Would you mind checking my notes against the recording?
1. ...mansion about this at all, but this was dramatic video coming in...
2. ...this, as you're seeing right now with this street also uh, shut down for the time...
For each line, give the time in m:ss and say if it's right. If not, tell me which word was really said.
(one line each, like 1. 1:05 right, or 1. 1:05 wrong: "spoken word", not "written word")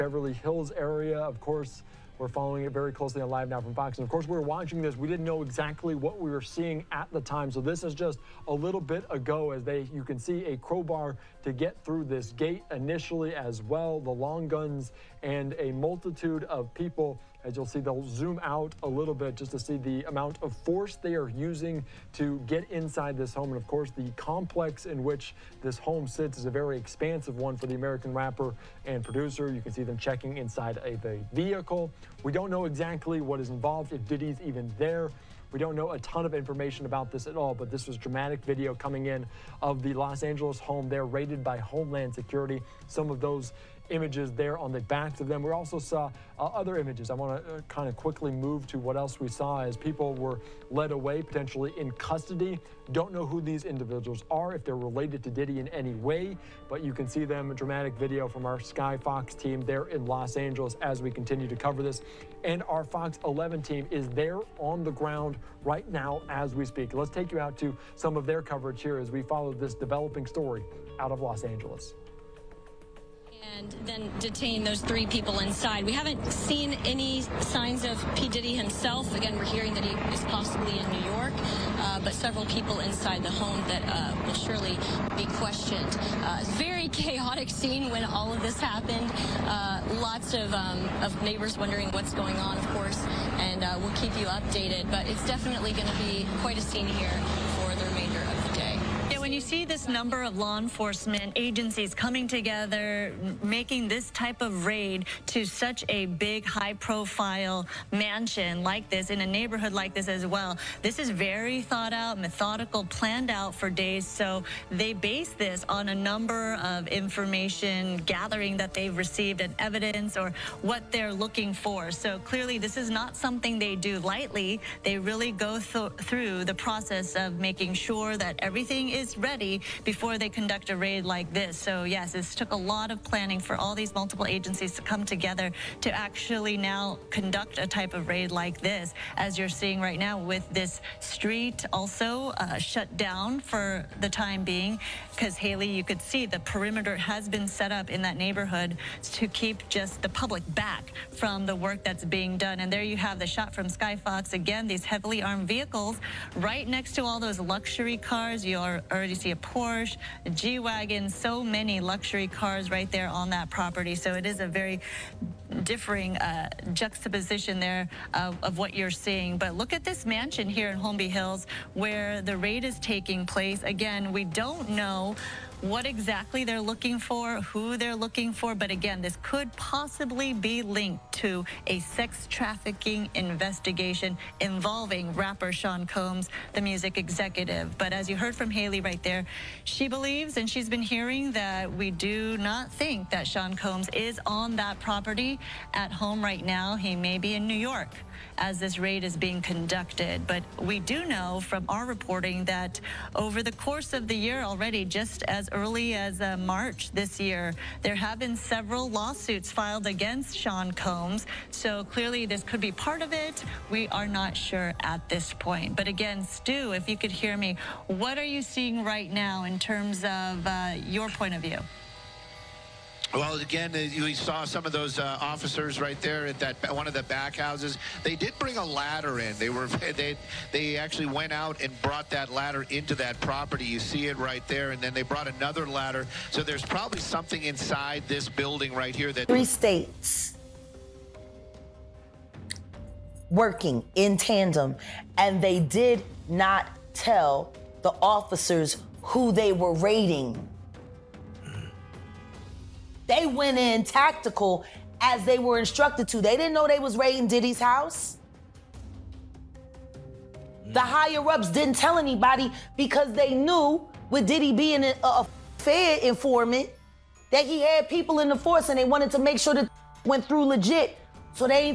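1. 0:36 wrong: "information", not "mansion"
2. 2:18 right.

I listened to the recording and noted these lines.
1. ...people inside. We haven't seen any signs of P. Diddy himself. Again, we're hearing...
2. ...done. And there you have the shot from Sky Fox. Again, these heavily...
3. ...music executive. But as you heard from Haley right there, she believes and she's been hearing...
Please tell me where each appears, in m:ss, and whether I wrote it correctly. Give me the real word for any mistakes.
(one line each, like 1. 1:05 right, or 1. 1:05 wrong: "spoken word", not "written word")
1. 1:15 right
2. 2:32 right
3. 3:06 right.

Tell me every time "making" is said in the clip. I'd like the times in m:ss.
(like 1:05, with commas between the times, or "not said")
1:43, 2:07.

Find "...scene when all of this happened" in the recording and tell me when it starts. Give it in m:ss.
1:27.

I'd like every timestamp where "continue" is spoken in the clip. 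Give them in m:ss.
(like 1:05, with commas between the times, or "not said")
1:01.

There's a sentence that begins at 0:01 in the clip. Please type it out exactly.
Of course, we're following it very closely on Live Now from Fox.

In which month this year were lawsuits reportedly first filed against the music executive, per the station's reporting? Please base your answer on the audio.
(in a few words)
March.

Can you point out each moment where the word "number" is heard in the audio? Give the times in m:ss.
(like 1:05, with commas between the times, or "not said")
1:39, 1:55.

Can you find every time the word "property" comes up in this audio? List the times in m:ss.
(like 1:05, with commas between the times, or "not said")
2:43, 3:14, 3:53.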